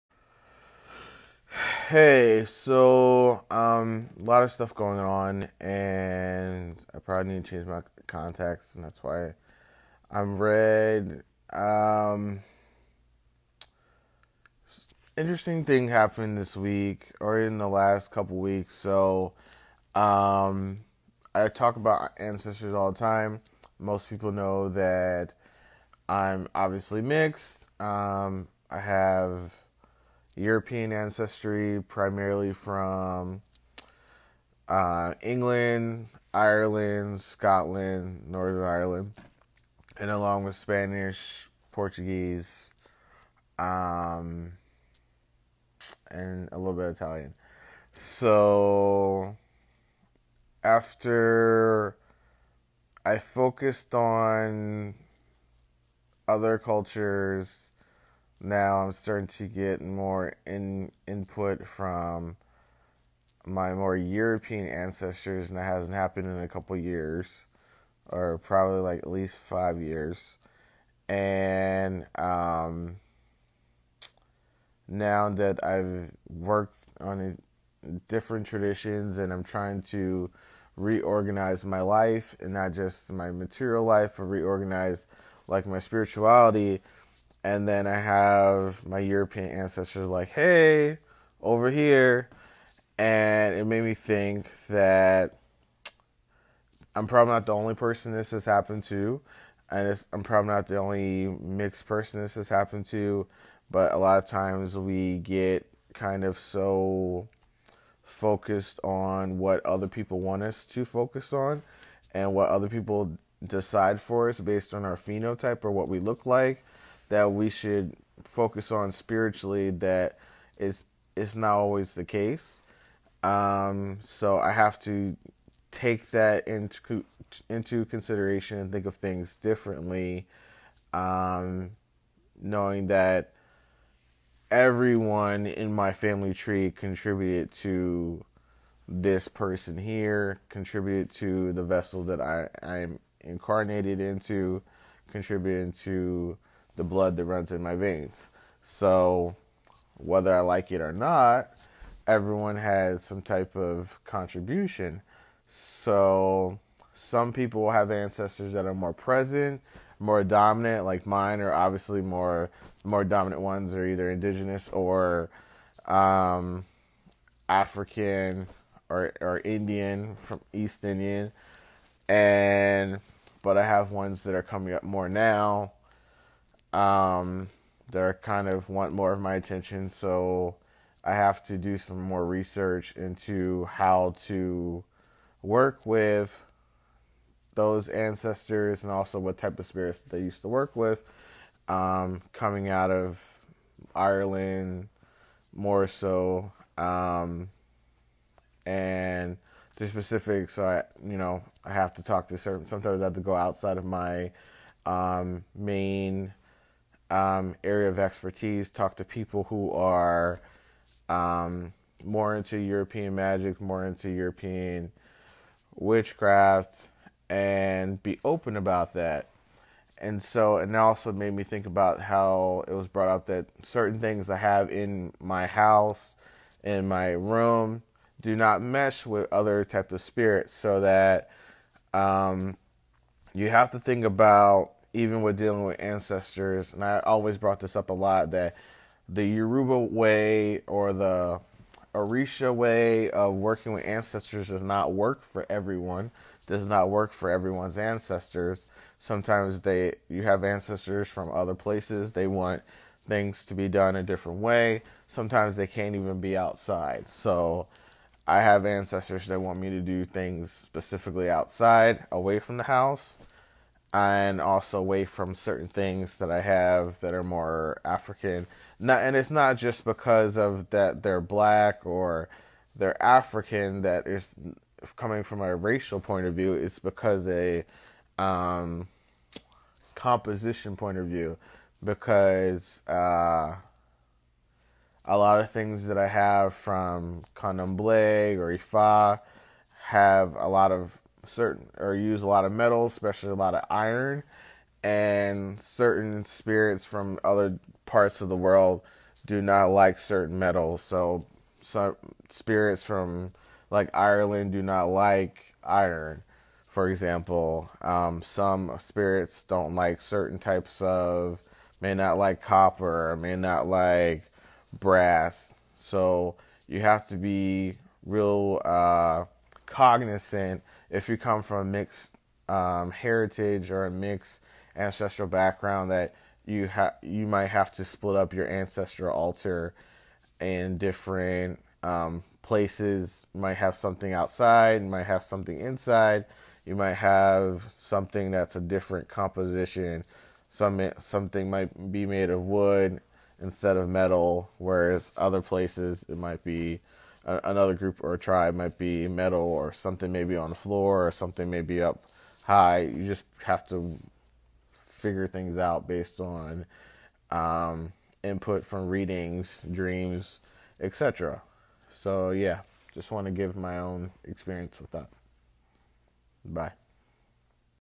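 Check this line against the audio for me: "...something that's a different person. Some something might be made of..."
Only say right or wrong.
wrong.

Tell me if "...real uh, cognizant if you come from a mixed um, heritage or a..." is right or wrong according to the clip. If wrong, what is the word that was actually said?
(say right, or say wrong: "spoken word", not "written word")
right.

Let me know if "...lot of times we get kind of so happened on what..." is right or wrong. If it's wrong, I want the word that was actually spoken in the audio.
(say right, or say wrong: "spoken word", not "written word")
wrong: "focused", not "happened".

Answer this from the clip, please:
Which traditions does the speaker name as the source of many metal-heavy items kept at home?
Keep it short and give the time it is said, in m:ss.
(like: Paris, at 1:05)
Candomblé or Ifa, at 4:47.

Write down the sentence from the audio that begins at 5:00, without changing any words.
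So some spirits from like Ireland do not like iron, for example.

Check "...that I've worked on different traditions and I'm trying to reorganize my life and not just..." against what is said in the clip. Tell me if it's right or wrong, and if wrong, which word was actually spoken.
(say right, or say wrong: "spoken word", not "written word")
right.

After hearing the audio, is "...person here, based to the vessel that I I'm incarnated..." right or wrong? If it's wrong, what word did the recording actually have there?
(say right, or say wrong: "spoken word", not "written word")
wrong: "contributed", not "based".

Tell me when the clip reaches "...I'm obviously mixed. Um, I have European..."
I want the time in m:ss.
0:26.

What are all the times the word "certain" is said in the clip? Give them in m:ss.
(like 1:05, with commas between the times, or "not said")
3:22, 3:43, 4:25, 4:51, 4:55, 4:59, 5:10.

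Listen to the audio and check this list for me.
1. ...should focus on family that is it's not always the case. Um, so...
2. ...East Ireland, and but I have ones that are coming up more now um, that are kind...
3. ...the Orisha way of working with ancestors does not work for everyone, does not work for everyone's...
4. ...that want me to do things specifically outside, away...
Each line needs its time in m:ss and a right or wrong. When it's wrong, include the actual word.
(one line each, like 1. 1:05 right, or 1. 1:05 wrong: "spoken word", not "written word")
1. 1:57 wrong: "spiritually", not "family"
2. 2:50 wrong: "Indian", not "Ireland"
3. 4:00 right
4. 4:19 right.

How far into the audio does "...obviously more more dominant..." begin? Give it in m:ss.
2:41.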